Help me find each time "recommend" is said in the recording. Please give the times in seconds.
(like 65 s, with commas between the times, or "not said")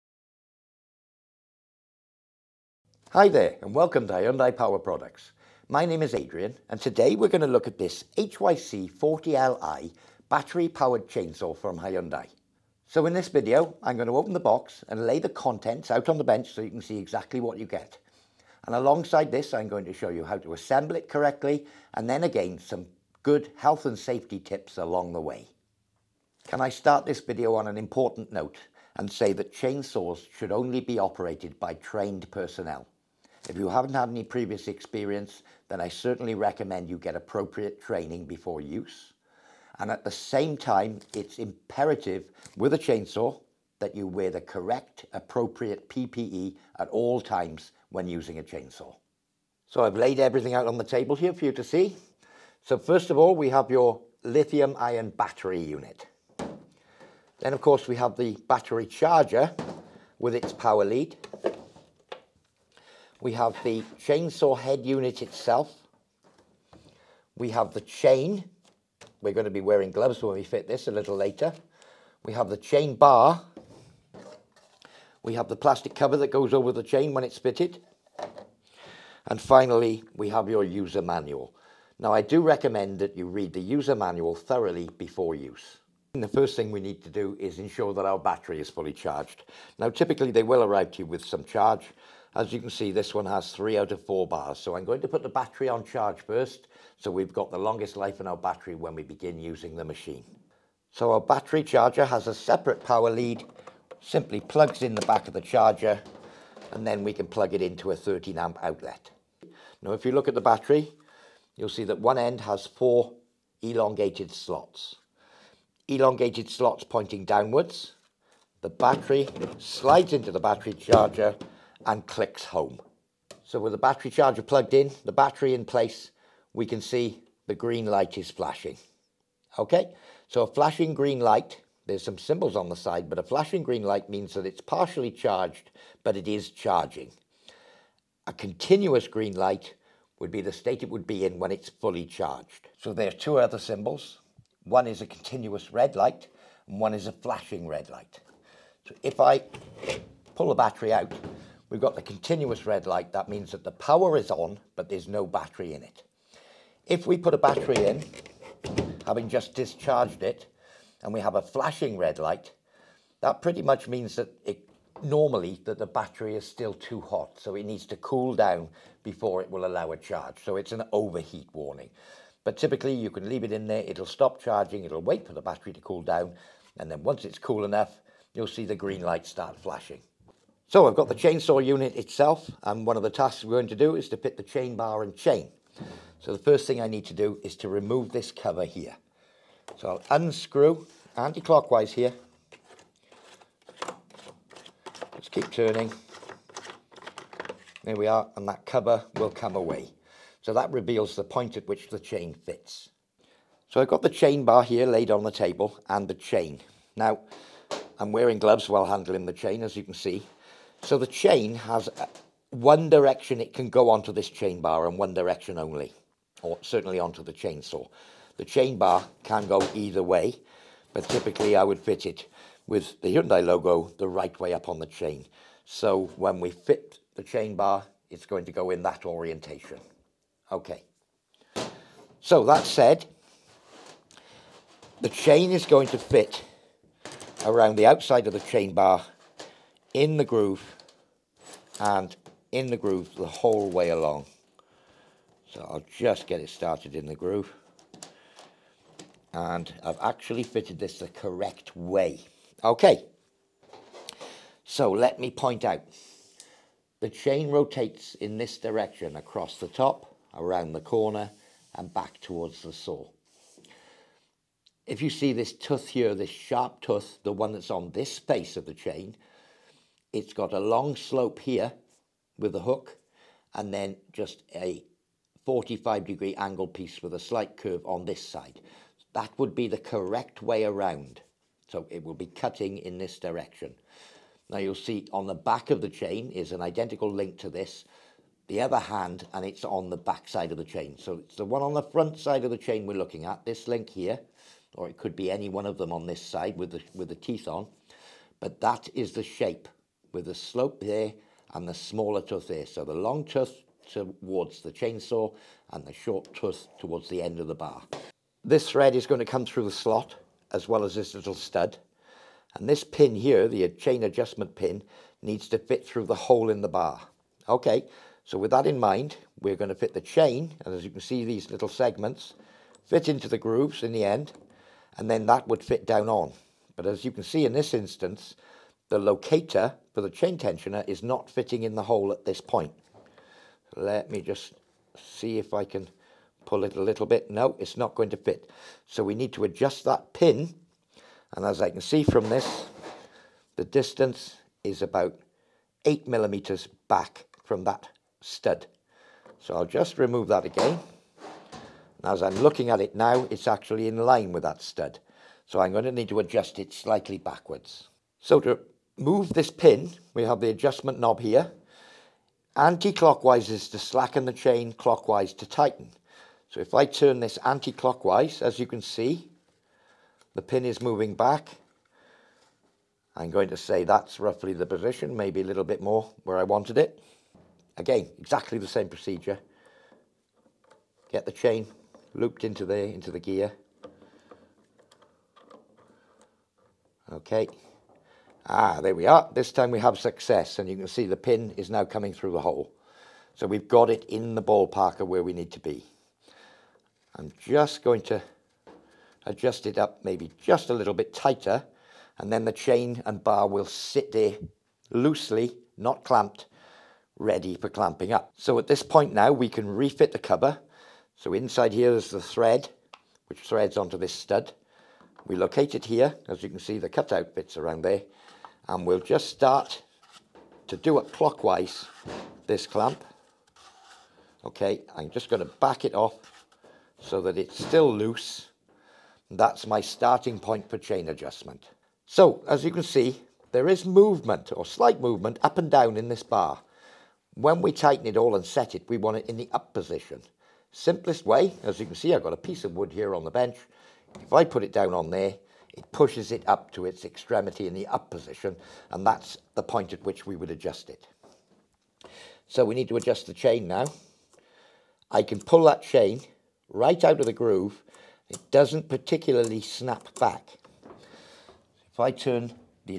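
36 s, 82 s.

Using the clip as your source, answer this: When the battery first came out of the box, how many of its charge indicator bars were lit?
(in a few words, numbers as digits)
3 out of 4.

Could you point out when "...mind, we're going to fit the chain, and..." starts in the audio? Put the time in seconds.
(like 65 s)
318 s.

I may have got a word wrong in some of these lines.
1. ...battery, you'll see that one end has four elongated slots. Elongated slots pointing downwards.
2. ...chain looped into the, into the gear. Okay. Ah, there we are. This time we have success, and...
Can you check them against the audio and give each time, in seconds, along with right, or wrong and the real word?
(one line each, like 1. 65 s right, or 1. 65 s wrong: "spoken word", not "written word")
1. 110 s right
2. 381 s right.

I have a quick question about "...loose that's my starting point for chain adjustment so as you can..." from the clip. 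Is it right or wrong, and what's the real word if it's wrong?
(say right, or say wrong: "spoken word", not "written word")
right.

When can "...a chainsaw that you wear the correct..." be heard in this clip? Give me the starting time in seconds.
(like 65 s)
42 s.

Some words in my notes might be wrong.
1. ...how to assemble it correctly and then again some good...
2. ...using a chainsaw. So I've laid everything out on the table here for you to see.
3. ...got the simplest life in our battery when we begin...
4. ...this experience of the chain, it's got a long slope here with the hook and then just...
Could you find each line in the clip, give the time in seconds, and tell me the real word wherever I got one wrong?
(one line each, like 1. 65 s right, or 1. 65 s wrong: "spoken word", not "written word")
1. 20 s right
2. 48 s right
3. 97 s wrong: "longest", not "simplest"
4. 267 s wrong: "space", not "experience".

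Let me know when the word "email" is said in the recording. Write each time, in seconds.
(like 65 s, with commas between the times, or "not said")
not said.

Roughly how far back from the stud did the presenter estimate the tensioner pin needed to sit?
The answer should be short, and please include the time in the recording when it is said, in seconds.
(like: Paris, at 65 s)
8 millimeters, at 345 s.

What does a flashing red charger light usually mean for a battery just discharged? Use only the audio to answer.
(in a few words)
Overheat warning.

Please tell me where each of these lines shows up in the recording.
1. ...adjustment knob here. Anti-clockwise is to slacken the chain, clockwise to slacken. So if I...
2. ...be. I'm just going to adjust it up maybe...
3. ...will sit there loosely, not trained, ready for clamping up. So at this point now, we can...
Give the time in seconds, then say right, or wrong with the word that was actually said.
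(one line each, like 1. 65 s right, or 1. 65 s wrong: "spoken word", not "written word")
1. 360 s wrong: "tighten", not "slacken"
2. 395 s right
3. 403 s wrong: "clamped", not "trained".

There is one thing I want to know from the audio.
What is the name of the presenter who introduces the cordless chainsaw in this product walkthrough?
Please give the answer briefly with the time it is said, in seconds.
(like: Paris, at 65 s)
Adrian, at 6 s.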